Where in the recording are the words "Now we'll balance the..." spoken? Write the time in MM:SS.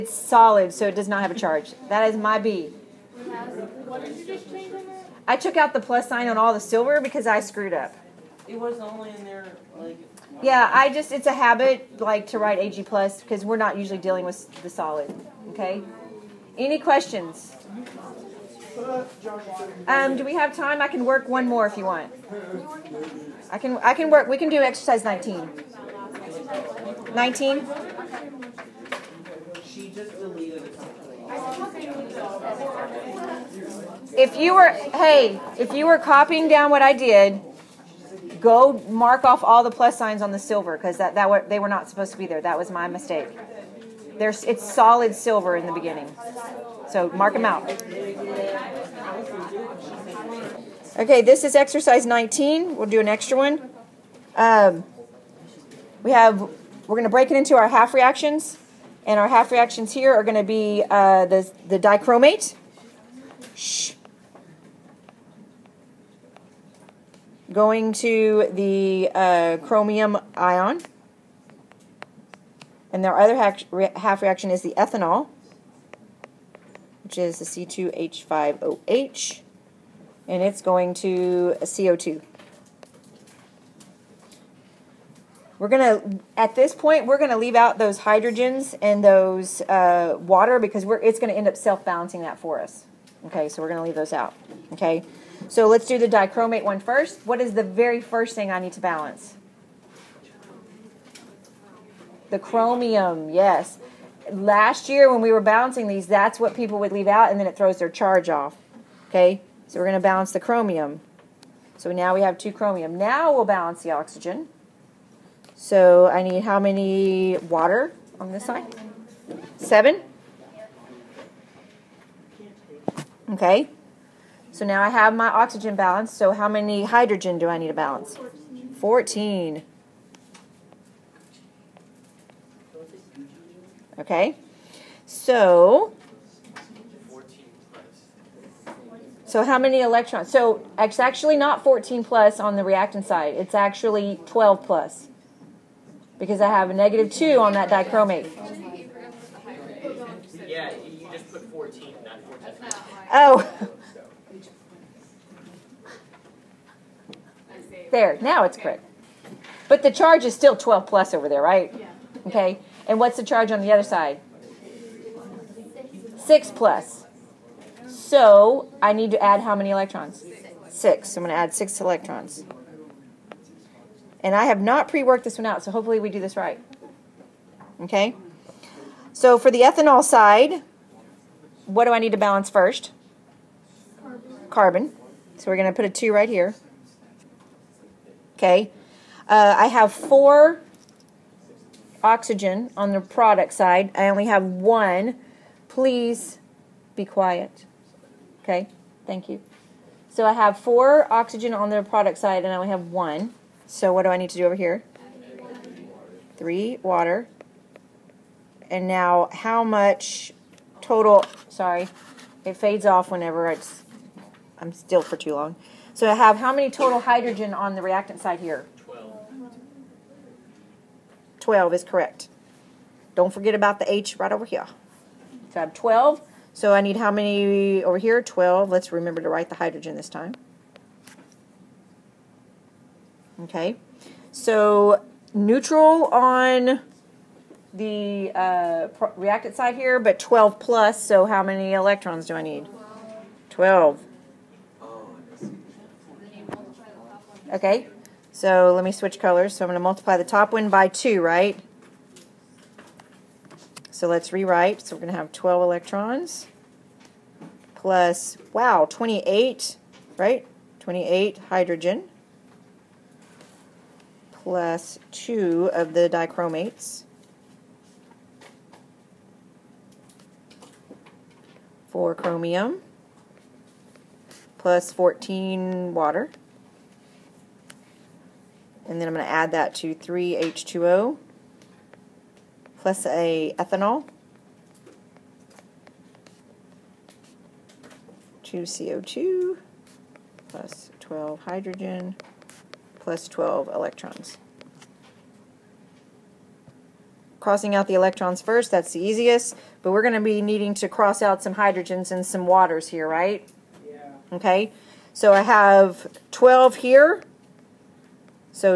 01:52.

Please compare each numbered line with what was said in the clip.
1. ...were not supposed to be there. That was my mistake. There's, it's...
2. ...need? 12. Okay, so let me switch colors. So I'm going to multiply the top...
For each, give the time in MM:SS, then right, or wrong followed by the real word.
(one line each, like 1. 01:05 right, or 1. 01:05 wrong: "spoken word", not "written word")
1. 00:41 right
2. 04:02 right.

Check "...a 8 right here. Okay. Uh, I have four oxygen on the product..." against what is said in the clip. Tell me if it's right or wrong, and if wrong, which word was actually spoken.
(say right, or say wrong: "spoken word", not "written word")
wrong: "2", not "8".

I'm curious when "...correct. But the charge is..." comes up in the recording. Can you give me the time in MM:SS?
02:38.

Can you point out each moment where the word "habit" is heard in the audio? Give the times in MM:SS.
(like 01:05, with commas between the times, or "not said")
00:11.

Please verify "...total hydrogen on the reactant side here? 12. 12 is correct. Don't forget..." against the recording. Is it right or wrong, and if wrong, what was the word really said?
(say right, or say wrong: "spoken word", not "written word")
right.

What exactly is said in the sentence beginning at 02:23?
It's actually 12 plus because I have a negative 2 on that dichromate.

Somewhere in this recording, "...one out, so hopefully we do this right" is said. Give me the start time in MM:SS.
02:55.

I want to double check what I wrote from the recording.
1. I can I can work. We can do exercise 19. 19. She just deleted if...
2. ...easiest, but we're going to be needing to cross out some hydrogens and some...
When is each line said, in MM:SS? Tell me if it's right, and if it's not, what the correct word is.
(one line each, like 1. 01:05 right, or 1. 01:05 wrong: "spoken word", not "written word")
1. 00:23 right
2. 04:58 right.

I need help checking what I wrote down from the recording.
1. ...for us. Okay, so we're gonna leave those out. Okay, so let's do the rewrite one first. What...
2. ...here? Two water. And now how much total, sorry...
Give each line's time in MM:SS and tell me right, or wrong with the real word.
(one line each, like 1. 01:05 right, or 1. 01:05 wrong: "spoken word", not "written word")
1. 01:32 wrong: "dichromate", not "rewrite"
2. 03:24 wrong: "Three", not "Two".